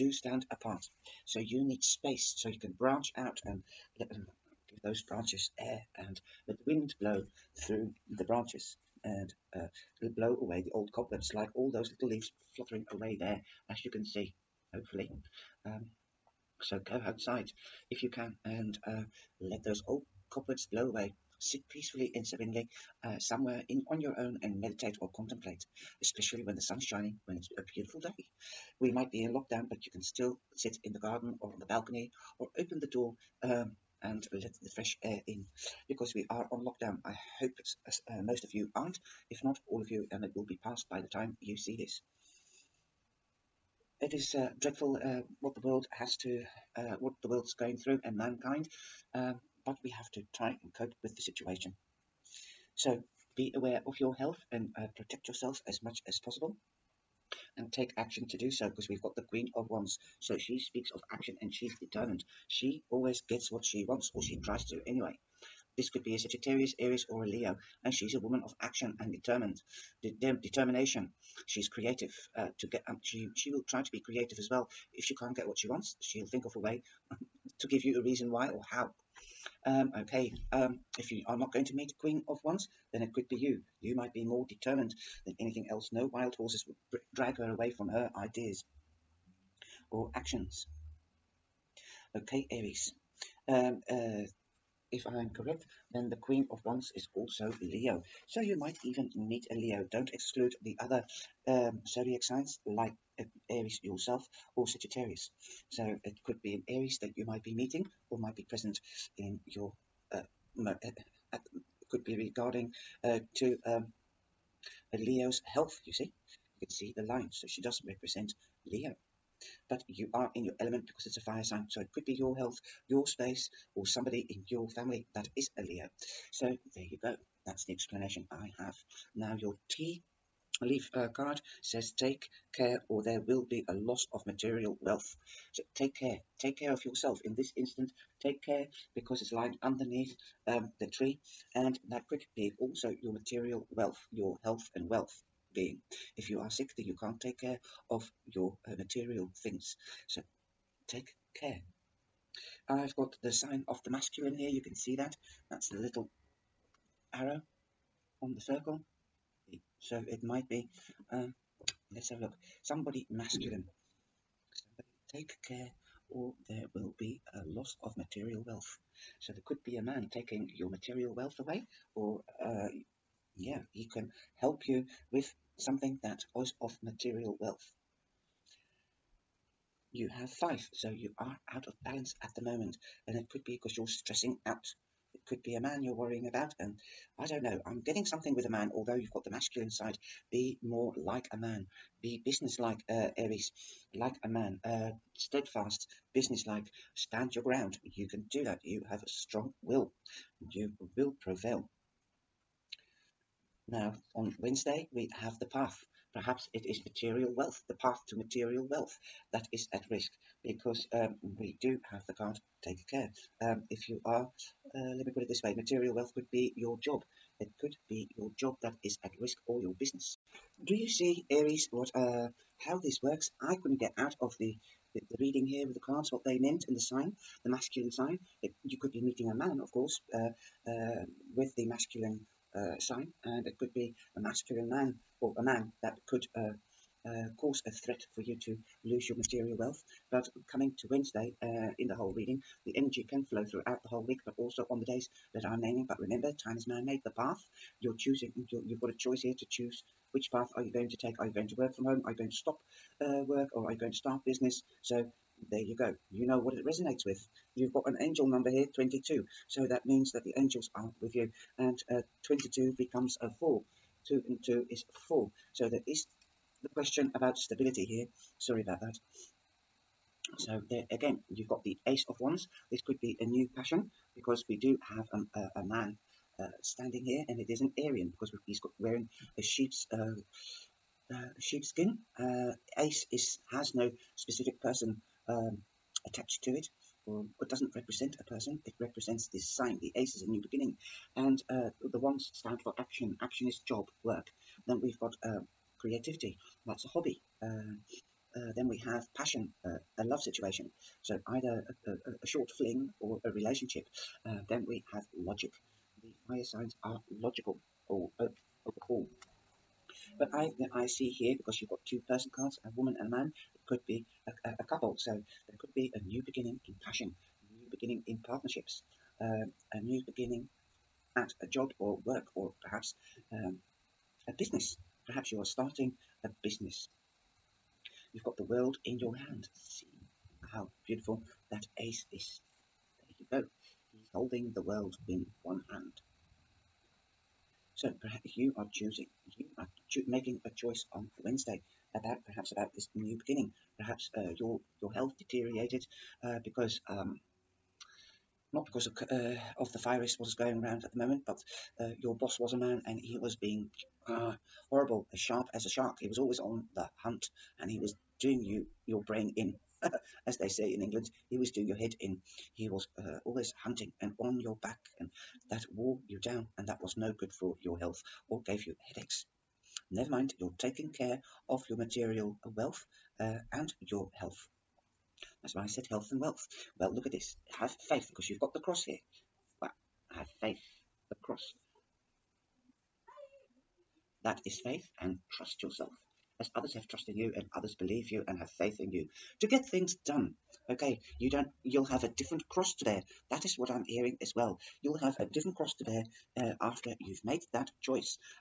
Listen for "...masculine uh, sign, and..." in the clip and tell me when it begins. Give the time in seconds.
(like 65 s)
231 s.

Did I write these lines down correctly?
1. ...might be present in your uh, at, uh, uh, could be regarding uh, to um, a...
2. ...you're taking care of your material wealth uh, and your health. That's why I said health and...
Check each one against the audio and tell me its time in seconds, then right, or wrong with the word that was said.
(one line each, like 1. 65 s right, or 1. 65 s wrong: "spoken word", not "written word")
1. 108 s right
2. 370 s right.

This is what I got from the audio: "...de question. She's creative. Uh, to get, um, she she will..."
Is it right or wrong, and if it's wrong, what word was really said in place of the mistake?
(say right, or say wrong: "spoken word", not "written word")
wrong: "determination", not "question".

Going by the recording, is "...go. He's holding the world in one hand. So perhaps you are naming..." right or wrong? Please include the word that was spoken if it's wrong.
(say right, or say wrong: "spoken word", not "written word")
wrong: "choosing", not "naming".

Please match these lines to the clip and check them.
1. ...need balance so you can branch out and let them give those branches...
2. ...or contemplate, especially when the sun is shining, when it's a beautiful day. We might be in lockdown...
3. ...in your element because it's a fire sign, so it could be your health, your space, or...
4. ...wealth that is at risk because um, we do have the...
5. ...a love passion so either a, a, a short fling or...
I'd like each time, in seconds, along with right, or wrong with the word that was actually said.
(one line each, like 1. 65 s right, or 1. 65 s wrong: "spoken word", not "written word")
1. 1 s wrong: "space", not "balance"
2. 24 s right
3. 120 s right
4. 208 s right
5. 299 s wrong: "situation", not "passion".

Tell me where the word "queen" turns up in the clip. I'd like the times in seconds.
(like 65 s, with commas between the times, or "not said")
59 s, 82 s, 96 s.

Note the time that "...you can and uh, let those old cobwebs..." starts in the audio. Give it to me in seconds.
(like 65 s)
18 s.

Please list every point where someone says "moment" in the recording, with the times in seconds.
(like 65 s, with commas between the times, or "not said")
182 s, 350 s.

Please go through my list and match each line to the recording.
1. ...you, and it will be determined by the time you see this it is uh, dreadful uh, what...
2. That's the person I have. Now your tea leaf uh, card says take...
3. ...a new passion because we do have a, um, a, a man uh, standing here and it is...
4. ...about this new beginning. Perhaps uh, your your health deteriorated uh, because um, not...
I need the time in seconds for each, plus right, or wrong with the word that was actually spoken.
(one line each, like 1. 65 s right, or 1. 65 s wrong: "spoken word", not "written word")
1. 39 s wrong: "passed", not "determined"
2. 127 s wrong: "explanation", not "person"
3. 273 s right
4. 342 s right.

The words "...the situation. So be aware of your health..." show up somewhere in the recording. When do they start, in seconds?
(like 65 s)
51 s.